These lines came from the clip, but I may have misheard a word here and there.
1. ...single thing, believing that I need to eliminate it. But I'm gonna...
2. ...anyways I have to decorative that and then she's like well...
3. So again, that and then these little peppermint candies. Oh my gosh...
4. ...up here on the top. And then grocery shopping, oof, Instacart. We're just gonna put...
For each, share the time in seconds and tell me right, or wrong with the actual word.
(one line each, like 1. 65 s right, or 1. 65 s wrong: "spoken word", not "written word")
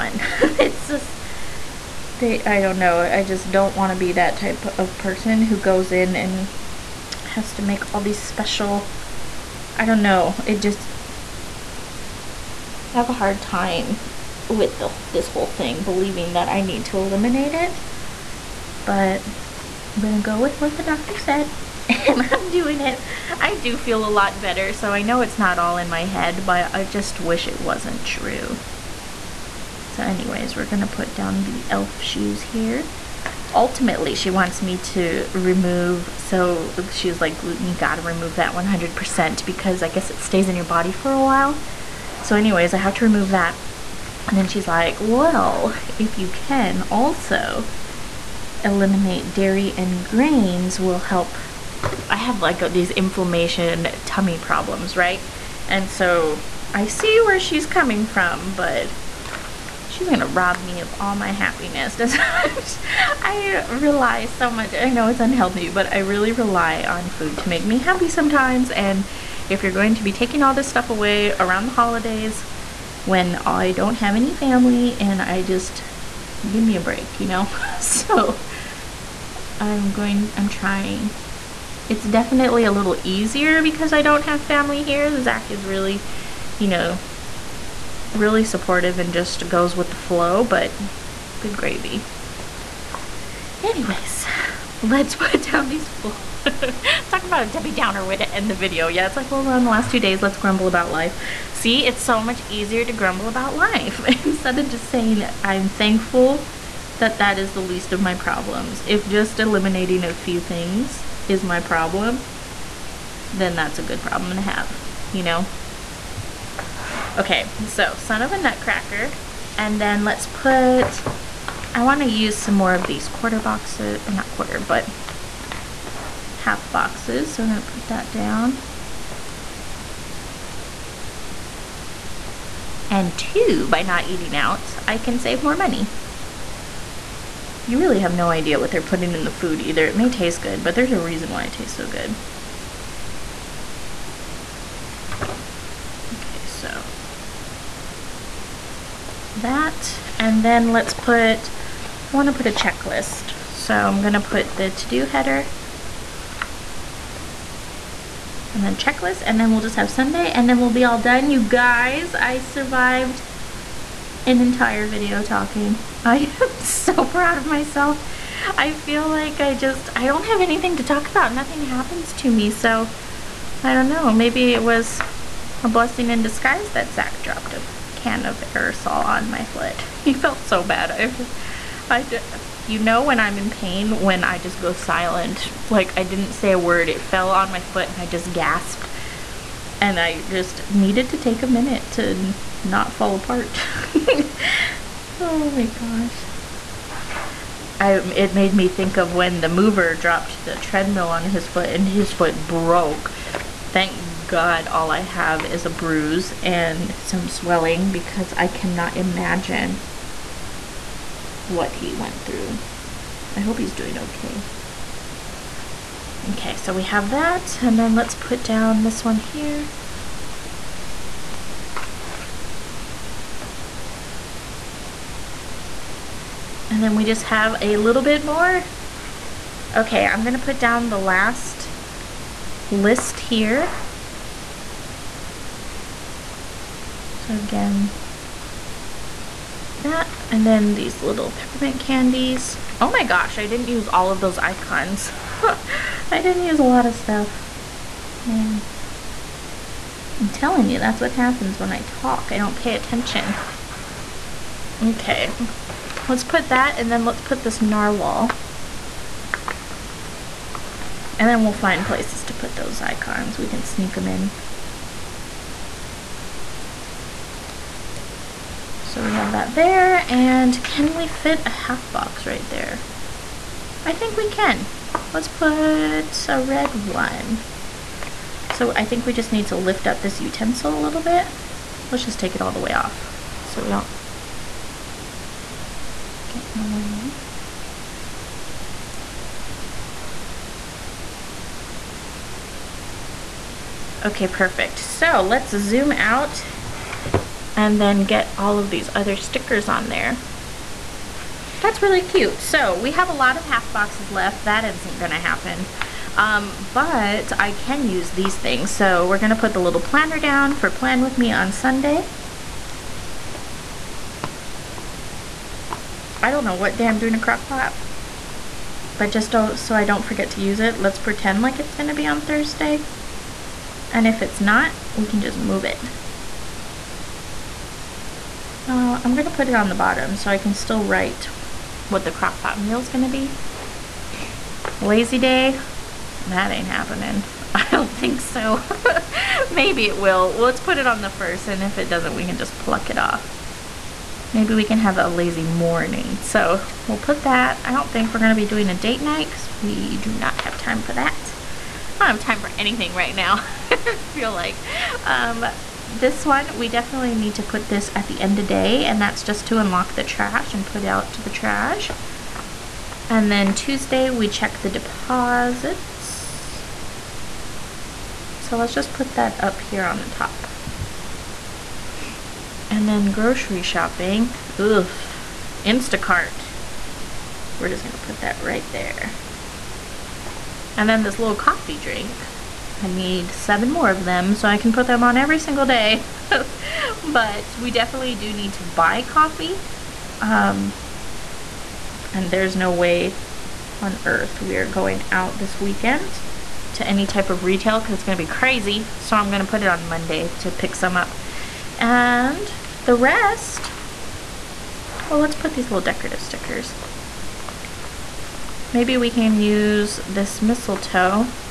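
1. 15 s wrong: "whole", not "single"
2. 42 s wrong: "remove", not "decorative"
3. 237 s right
4. 369 s right.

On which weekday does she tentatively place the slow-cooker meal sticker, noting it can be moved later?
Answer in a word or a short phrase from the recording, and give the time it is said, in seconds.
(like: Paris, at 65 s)
Thursday, at 322 s.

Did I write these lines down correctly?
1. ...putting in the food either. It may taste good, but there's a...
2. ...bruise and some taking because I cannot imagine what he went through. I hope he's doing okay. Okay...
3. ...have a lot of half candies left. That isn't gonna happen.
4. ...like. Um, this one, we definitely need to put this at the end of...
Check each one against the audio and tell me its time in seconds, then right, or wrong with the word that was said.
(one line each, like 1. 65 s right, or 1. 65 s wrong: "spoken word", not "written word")
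1. 138 s right
2. 205 s wrong: "swelling", not "taking"
3. 302 s wrong: "boxes", not "candies"
4. 354 s right.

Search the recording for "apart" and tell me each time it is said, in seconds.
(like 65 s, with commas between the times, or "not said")
193 s.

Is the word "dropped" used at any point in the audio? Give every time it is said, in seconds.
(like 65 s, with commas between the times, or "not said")
177 s, 199 s.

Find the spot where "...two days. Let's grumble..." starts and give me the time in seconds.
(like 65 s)
99 s.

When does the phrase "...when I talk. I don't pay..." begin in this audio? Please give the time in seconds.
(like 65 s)
251 s.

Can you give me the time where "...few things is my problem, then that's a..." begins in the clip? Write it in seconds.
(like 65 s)
110 s.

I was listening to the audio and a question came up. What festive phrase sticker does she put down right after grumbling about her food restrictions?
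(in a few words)
Son of a Nutcracker.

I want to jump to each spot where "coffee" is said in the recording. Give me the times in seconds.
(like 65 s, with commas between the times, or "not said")
381 s, 389 s.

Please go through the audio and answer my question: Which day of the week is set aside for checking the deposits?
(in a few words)
Tuesday.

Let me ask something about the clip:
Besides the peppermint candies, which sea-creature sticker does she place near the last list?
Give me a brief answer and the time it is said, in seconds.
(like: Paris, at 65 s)
narwhal, at 257 s.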